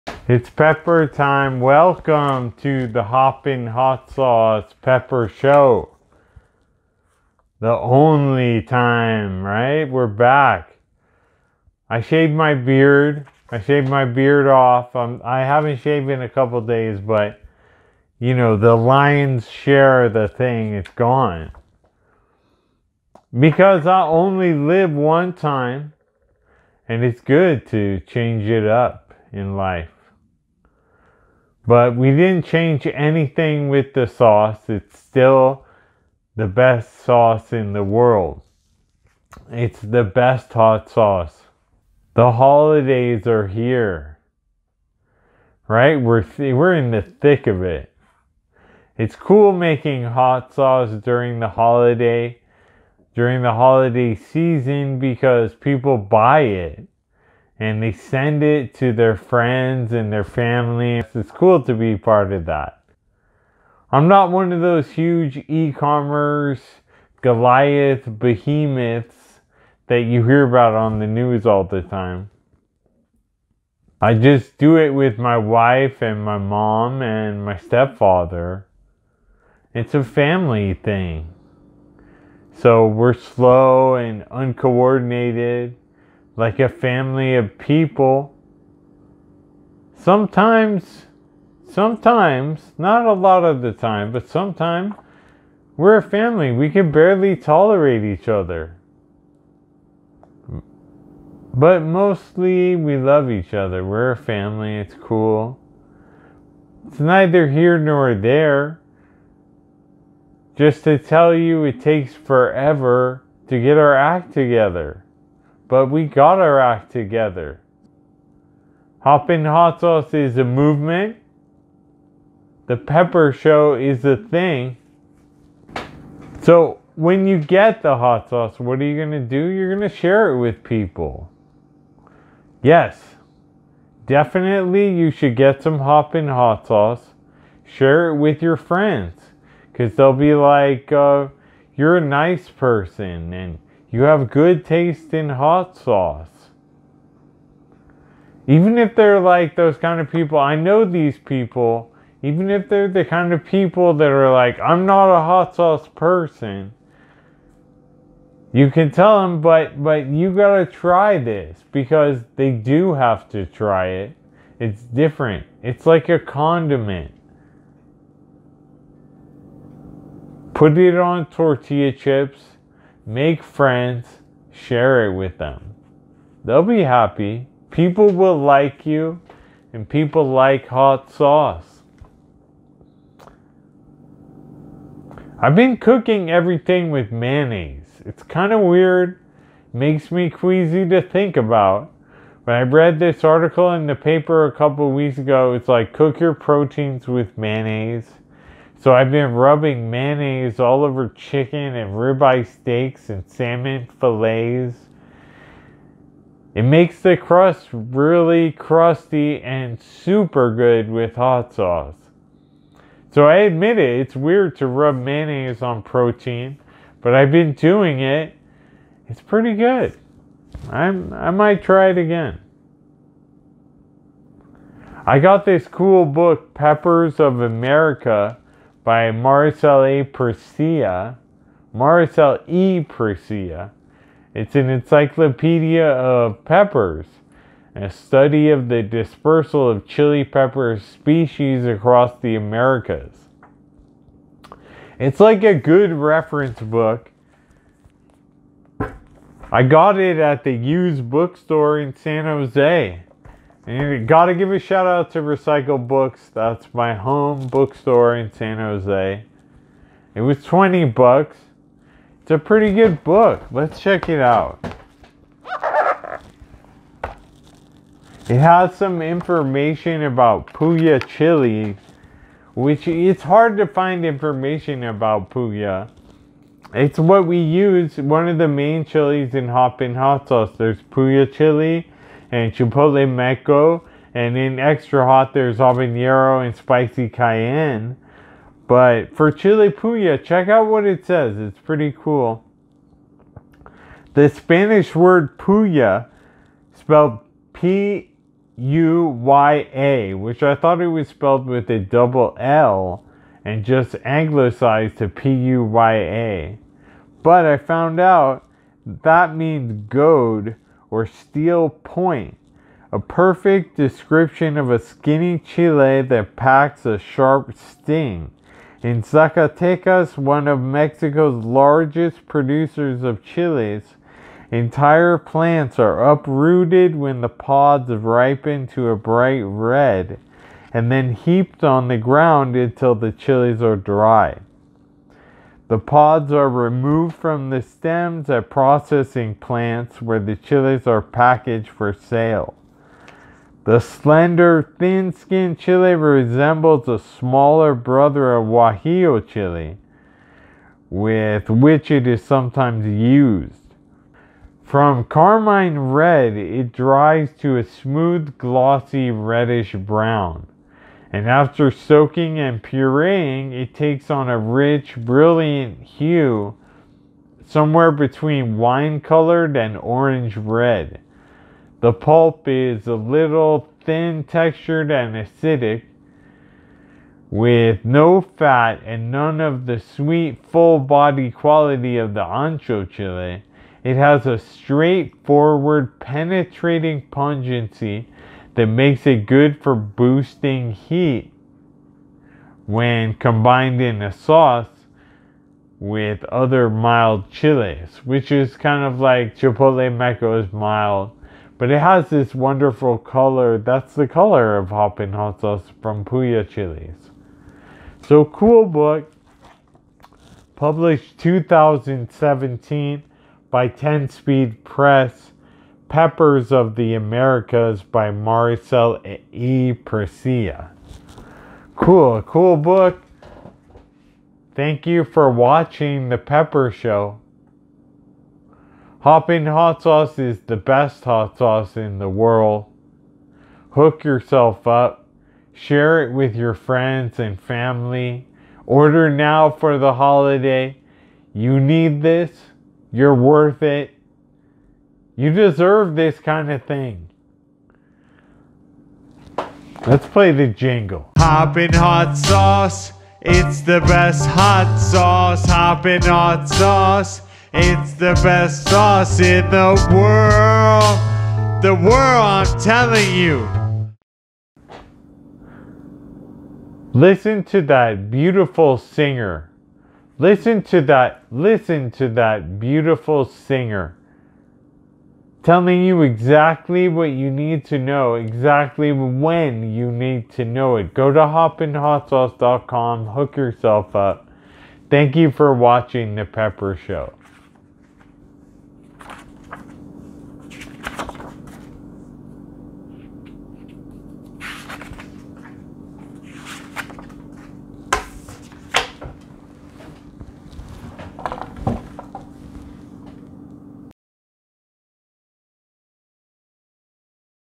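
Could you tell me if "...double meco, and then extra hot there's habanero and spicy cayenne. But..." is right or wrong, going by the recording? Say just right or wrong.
wrong.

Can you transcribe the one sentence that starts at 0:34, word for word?
It's still the best sauce in the world.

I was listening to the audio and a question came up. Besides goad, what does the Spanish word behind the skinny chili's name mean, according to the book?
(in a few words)
steel point.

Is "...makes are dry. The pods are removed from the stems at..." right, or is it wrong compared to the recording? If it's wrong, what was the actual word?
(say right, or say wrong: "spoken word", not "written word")
wrong: "chilies", not "makes".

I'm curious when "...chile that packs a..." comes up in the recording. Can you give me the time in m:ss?
5:15.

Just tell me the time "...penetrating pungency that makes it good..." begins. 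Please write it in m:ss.
6:25.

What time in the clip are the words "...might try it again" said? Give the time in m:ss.
3:41.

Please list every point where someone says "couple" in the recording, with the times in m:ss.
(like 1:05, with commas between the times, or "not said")
0:16, 3:14.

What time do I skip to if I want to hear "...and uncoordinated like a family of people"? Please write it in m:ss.
1:23.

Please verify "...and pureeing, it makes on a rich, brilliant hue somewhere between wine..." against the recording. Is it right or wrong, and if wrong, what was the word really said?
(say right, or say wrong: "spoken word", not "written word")
wrong: "takes", not "makes".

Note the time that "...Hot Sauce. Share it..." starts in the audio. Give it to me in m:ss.
2:16.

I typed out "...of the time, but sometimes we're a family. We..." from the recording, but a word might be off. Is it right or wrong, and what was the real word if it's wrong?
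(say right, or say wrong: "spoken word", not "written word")
right.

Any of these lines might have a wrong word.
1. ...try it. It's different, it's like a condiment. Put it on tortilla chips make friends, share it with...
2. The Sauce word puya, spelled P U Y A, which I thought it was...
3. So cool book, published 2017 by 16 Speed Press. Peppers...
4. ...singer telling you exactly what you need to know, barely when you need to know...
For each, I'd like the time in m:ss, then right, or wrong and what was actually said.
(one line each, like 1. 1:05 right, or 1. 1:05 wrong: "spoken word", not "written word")
1. 2:43 right
2. 4:54 wrong: "Spanish", not "Sauce"
3. 6:48 wrong: "10", not "16"
4. 7:53 wrong: "exactly", not "barely".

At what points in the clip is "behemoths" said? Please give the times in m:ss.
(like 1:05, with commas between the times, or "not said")
1:08.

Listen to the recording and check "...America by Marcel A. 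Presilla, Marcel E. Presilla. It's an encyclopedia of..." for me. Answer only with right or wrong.
right.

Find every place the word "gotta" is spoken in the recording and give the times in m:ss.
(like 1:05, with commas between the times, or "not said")
2:40, 4:14.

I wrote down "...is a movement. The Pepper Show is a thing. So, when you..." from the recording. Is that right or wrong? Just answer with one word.
right.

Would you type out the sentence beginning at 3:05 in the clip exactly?
I've been cooking everything with mayonnaise.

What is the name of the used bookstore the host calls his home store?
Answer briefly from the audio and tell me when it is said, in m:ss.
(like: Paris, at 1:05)
Recycle Books, at 4:15.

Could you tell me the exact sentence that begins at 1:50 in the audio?
Just to tell you, it takes forever to get our act together but we got our act together.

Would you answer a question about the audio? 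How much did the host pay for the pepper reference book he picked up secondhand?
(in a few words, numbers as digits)
$20.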